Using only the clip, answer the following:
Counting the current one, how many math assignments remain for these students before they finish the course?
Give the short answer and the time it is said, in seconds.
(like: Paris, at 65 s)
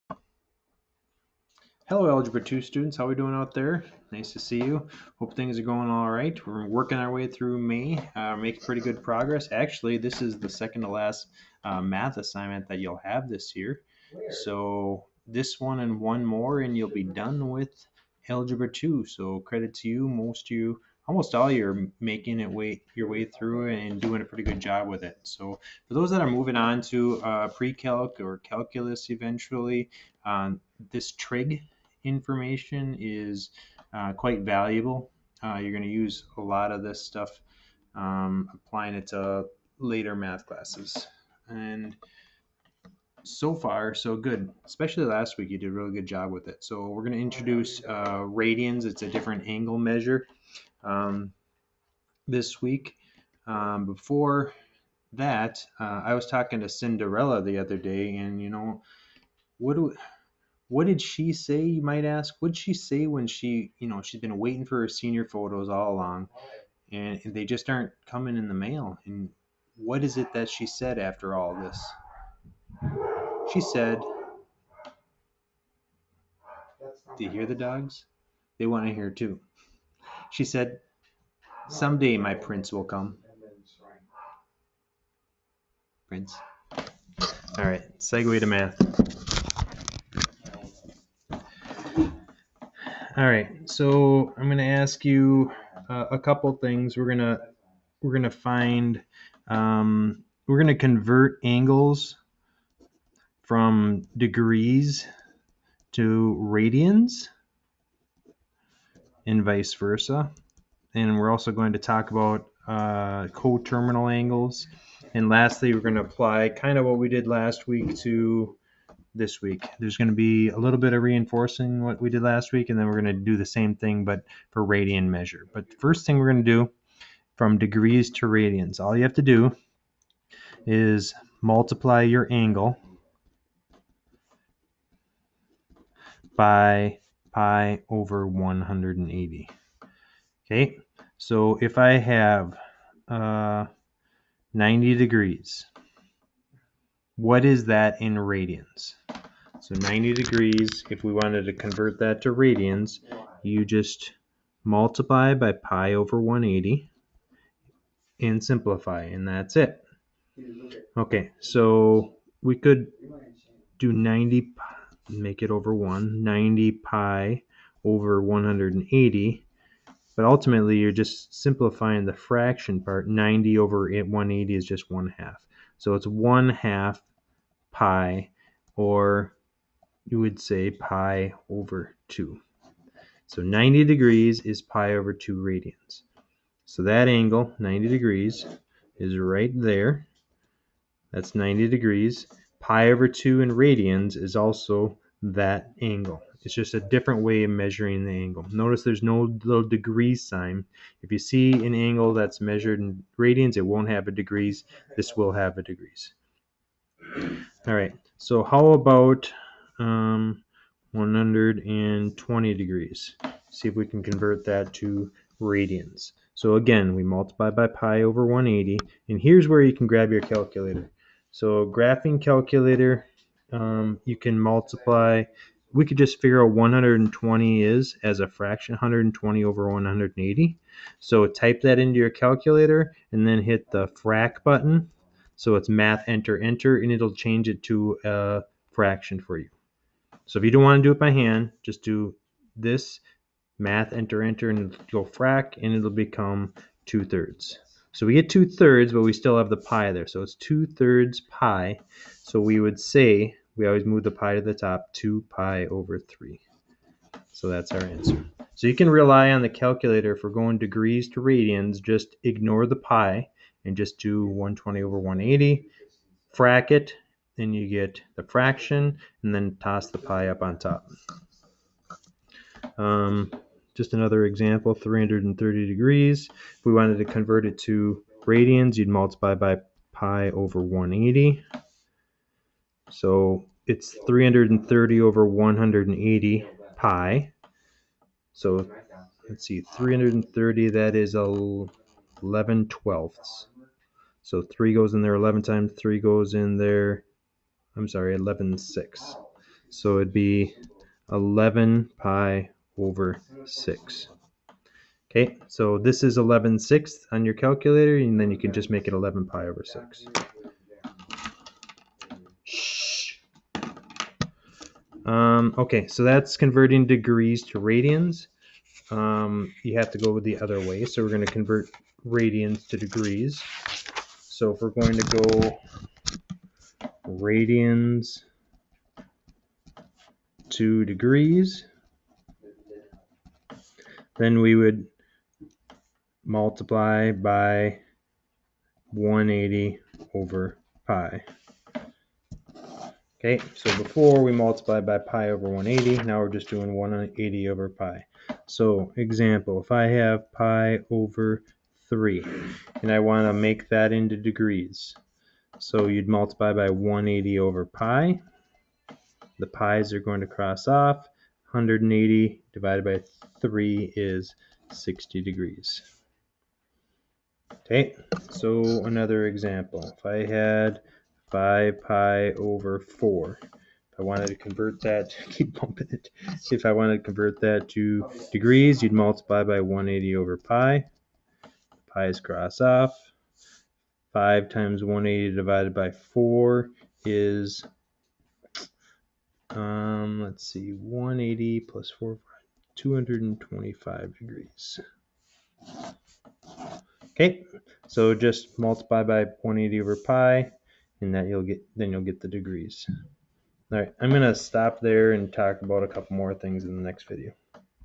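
2, at 10 s.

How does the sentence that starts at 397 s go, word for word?
Okay, so just multiply by 180 over pi, and that you'll get, then you'll get the degrees.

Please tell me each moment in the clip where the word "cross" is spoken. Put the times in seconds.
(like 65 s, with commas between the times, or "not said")
360 s, 382 s.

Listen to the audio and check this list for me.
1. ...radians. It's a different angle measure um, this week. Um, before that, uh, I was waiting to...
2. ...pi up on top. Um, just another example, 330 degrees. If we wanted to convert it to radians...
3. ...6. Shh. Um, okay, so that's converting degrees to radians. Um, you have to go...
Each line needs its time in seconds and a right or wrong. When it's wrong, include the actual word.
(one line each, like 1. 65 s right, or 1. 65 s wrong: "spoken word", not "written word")
1. 48 s wrong: "talking", not "waiting"
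2. 269 s right
3. 309 s right.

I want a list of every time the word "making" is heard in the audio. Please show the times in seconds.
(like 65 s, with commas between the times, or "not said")
8 s, 21 s.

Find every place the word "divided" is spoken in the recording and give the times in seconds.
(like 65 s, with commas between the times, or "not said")
362 s, 385 s.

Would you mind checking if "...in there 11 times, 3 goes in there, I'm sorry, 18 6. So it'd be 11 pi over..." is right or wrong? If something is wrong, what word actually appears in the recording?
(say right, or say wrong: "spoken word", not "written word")
wrong: "11", not "18".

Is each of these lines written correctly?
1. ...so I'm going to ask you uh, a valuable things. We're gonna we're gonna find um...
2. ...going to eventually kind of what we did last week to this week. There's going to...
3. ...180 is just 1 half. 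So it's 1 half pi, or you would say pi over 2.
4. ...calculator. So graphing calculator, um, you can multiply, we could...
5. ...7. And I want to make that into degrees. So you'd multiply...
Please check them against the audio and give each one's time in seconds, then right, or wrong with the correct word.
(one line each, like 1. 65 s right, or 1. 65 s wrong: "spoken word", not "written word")
1. 93 s wrong: "couple", not "valuable"
2. 115 s wrong: "apply", not "eventually"
3. 173 s right
4. 220 s right
5. 351 s wrong: "3", not "7".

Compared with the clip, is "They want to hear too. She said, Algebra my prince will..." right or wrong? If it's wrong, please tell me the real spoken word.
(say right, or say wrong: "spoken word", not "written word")
wrong: "Someday", not "Algebra".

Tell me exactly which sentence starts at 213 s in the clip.
See if we can convert that to radians.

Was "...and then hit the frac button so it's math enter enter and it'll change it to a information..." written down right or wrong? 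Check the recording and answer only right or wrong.
wrong.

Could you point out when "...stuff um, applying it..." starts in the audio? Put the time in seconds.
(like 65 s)
37 s.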